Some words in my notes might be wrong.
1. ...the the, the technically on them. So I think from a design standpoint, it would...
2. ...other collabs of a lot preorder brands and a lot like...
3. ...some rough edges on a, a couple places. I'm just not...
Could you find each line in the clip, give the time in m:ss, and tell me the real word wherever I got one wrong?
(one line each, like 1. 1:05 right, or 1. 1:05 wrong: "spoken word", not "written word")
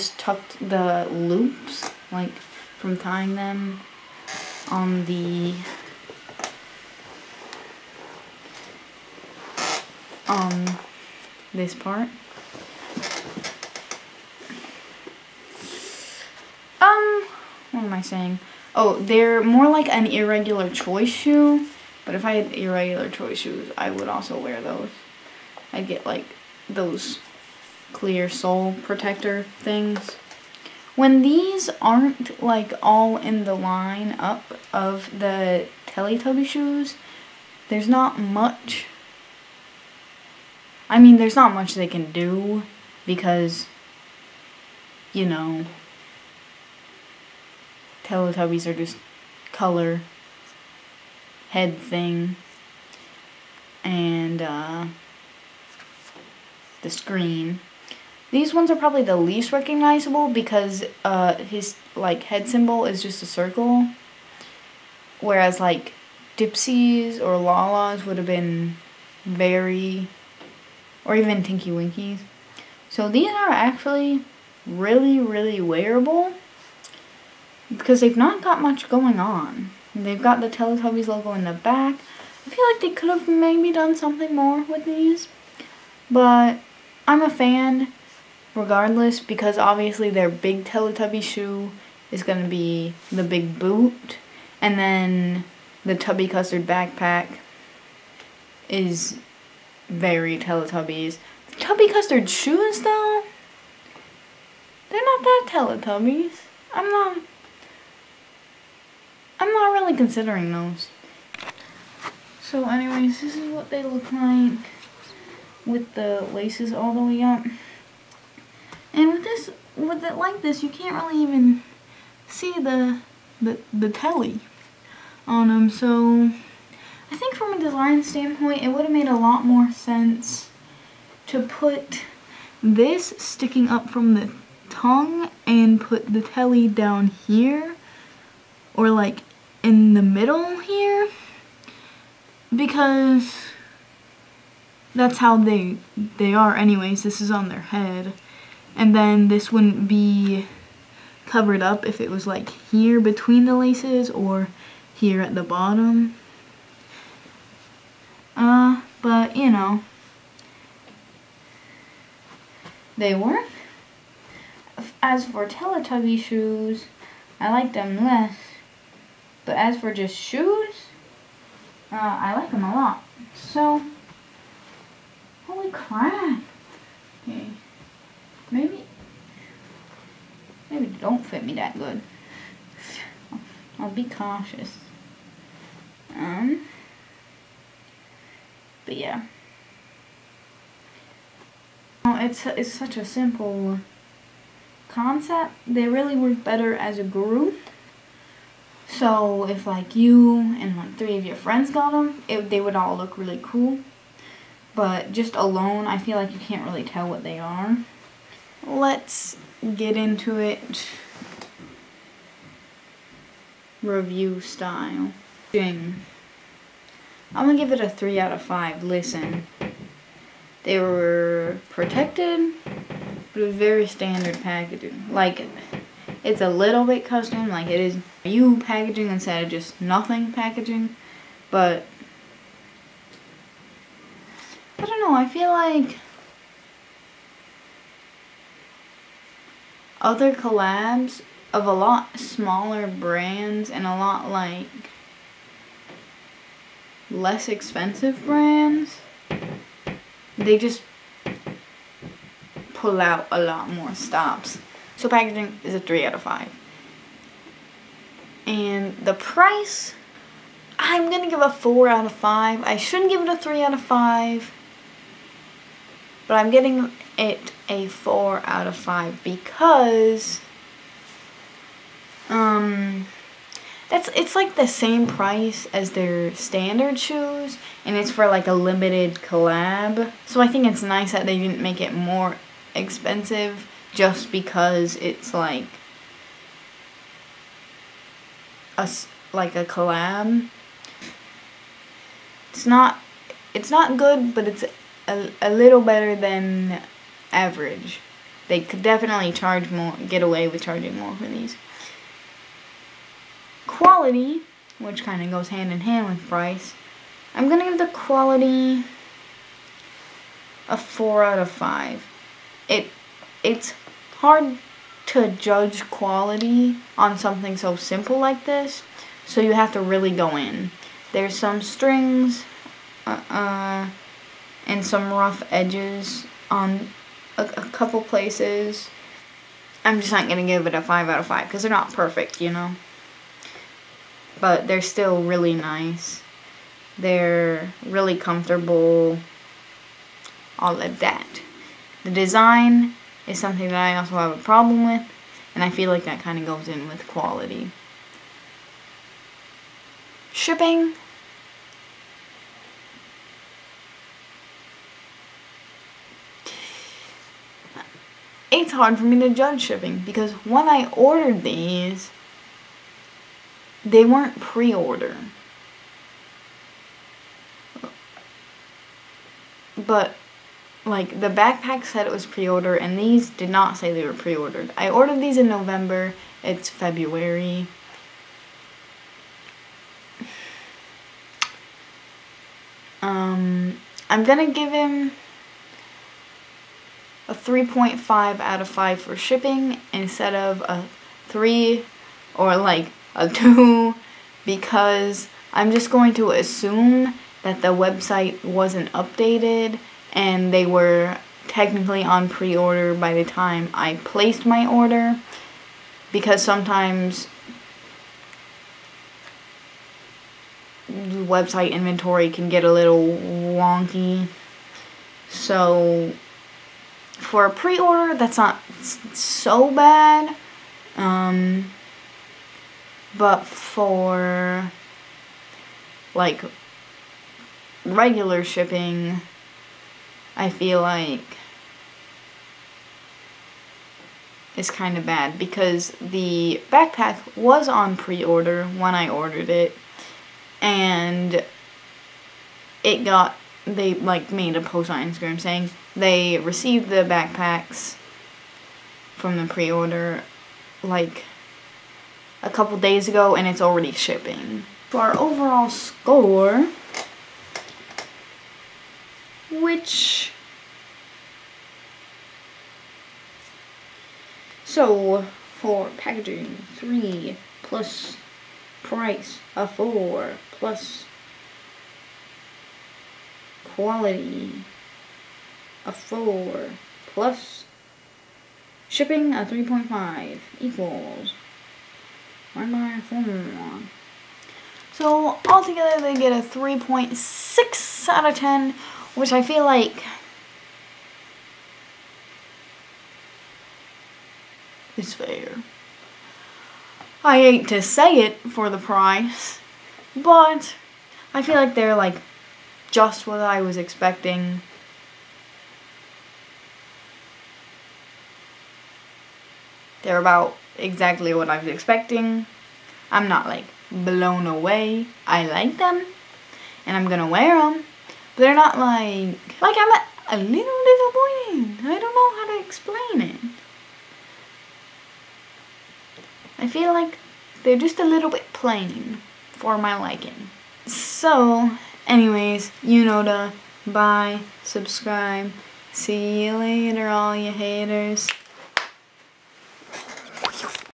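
1. 2:02 wrong: "telly", not "technically"
2. 4:00 wrong: "smaller", not "preorder"
3. 5:24 right.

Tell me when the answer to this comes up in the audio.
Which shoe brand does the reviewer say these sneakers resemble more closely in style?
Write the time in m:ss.
0:20.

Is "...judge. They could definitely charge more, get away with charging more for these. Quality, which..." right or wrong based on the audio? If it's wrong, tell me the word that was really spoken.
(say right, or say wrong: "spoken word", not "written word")
wrong: "average", not "judge".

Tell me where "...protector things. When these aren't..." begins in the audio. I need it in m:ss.
0:28.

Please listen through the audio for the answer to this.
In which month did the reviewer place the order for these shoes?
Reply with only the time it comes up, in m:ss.
6:15.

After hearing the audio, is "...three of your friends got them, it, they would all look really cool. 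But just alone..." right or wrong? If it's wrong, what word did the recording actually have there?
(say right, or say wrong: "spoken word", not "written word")
right.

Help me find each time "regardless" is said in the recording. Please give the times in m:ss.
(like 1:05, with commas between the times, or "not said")
1:28.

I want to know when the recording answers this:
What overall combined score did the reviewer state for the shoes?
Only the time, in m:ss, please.
8:06.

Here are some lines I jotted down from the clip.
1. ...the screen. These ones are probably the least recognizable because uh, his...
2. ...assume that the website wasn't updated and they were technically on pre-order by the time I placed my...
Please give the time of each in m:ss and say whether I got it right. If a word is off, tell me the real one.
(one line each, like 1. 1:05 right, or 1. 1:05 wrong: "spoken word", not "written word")
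1. 0:56 right
2. 6:36 right.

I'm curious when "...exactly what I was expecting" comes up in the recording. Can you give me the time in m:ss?
8:30.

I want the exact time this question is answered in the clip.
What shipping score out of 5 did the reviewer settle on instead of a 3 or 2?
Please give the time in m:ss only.
6:27.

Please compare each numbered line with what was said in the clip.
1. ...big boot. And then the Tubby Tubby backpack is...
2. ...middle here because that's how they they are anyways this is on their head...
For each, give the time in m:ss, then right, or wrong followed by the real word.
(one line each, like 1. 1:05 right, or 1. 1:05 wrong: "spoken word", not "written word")
1. 1:33 wrong: "Custard", not "Tubby"
2. 2:20 right.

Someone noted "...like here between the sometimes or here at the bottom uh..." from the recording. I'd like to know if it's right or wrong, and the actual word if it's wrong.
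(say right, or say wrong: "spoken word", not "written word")
wrong: "laces", not "sometimes".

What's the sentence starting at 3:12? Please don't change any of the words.
It's, it's such a simple concept.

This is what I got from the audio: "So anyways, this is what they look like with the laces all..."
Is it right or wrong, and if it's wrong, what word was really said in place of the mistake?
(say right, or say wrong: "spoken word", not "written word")
right.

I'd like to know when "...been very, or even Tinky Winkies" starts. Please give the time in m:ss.
1:08.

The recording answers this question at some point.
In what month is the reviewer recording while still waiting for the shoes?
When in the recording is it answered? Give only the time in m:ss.
6:16.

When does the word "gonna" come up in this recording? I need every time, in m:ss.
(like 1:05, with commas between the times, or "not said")
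3:37, 6:24, 8:37.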